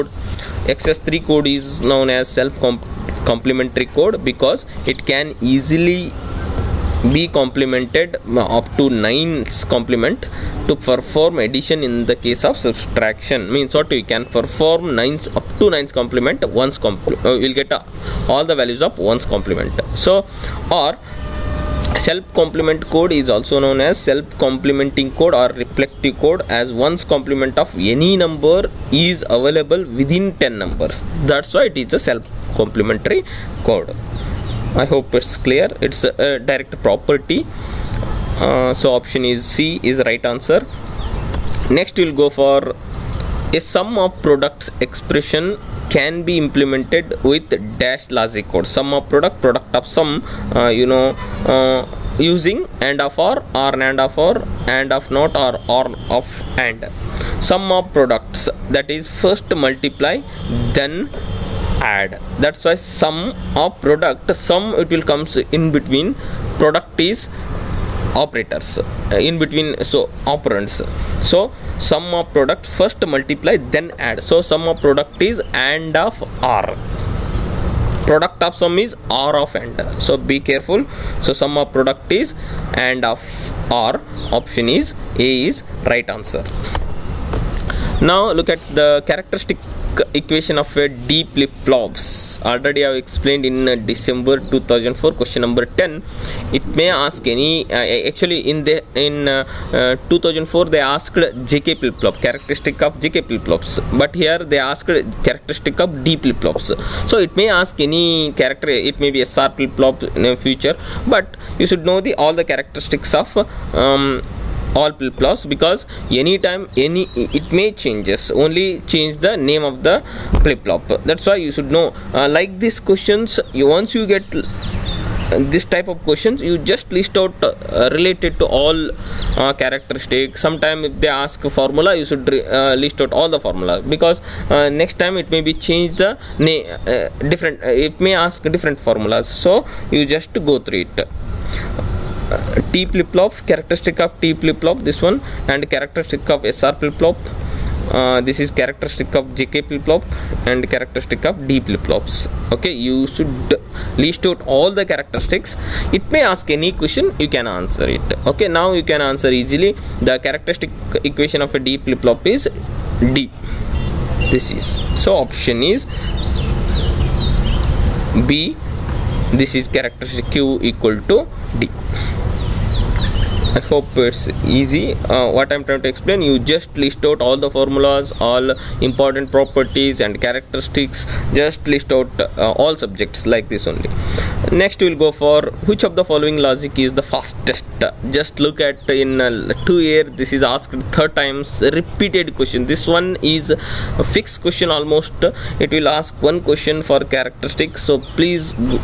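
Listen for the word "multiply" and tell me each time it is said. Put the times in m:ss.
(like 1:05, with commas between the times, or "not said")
0:59, 1:13.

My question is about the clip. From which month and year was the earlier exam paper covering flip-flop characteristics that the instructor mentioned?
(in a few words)
December 2004.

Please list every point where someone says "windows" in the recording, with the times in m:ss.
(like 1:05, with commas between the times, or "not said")
not said.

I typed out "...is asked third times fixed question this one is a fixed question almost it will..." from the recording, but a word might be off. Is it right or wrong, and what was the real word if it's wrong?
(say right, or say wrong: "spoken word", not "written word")
wrong: "repeated", not "fixed".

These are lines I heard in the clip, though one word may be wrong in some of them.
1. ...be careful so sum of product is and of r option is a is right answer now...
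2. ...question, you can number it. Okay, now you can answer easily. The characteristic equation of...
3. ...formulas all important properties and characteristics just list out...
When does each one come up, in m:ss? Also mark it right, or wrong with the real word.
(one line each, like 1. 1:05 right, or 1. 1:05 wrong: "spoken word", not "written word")
1. 1:20 right
2. 2:36 wrong: "answer", not "number"
3. 2:57 right.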